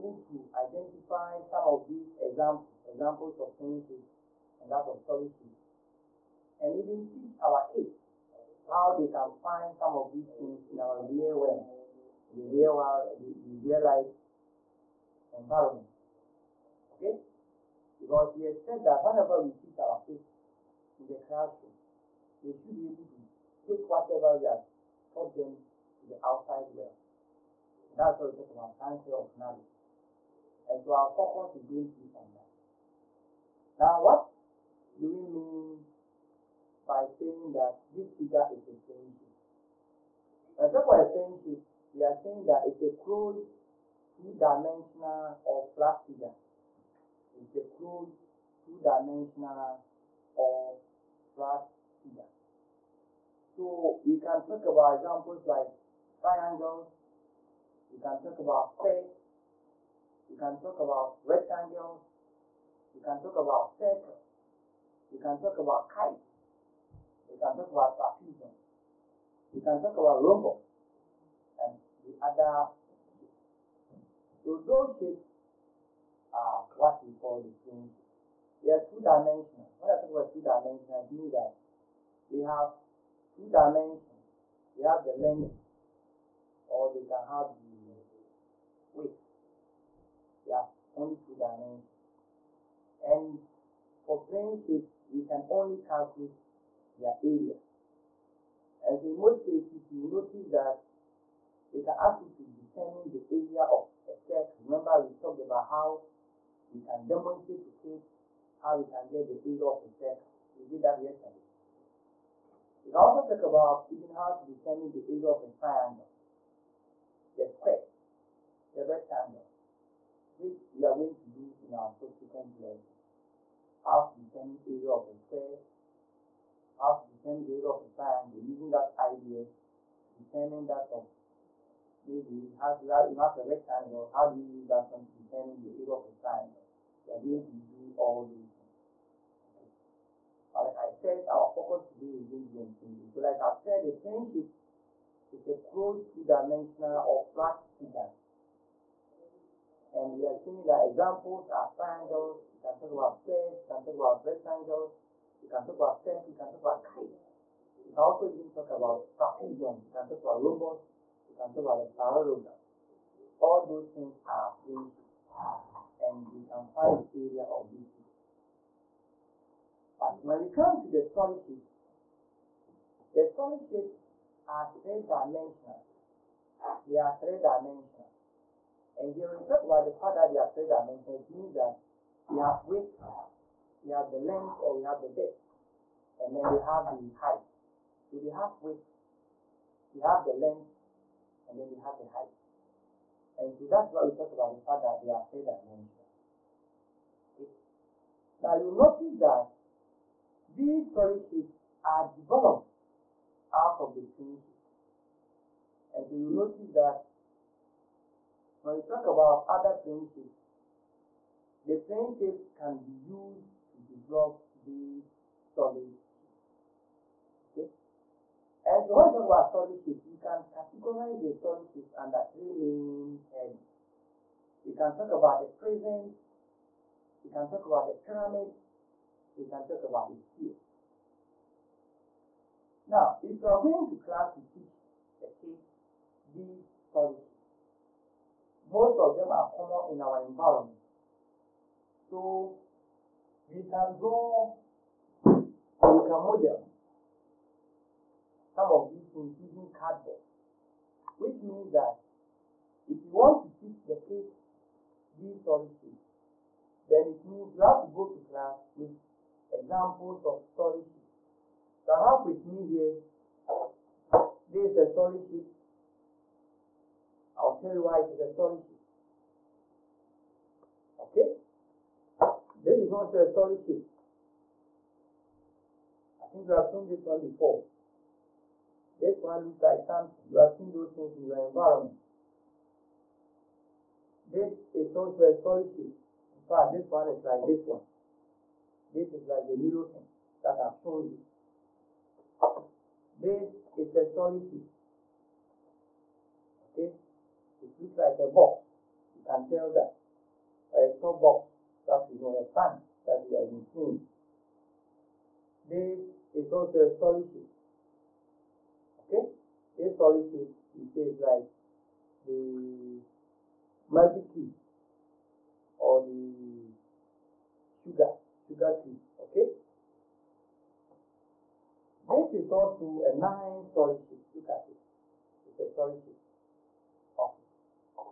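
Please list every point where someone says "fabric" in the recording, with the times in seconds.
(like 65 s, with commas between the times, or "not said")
not said.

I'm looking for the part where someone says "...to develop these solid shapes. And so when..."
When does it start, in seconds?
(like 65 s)
213 s.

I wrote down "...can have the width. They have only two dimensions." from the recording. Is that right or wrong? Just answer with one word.
right.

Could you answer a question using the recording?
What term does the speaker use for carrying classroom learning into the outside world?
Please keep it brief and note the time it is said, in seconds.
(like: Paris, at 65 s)
transfer of knowledge, at 28 s.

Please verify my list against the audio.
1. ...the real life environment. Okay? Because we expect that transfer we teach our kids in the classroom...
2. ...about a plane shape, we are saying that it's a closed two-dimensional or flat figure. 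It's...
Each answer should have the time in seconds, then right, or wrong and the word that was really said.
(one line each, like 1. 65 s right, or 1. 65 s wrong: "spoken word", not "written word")
1. 13 s wrong: "whenever", not "transfer"
2. 40 s right.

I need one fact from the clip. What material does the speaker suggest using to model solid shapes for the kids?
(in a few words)
cardboards.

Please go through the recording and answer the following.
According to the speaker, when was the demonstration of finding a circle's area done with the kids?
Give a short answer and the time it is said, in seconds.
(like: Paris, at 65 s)
yesterday, at 111 s.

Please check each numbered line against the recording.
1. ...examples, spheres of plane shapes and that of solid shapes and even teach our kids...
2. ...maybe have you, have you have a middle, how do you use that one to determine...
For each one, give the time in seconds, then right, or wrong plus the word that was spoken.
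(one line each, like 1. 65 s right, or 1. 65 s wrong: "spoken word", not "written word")
1. 2 s wrong: "examples", not "spheres"
2. 132 s wrong: "rectangle", not "middle".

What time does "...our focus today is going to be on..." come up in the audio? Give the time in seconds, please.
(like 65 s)
141 s.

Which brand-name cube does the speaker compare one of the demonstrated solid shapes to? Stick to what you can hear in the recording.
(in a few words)
Maggi cube.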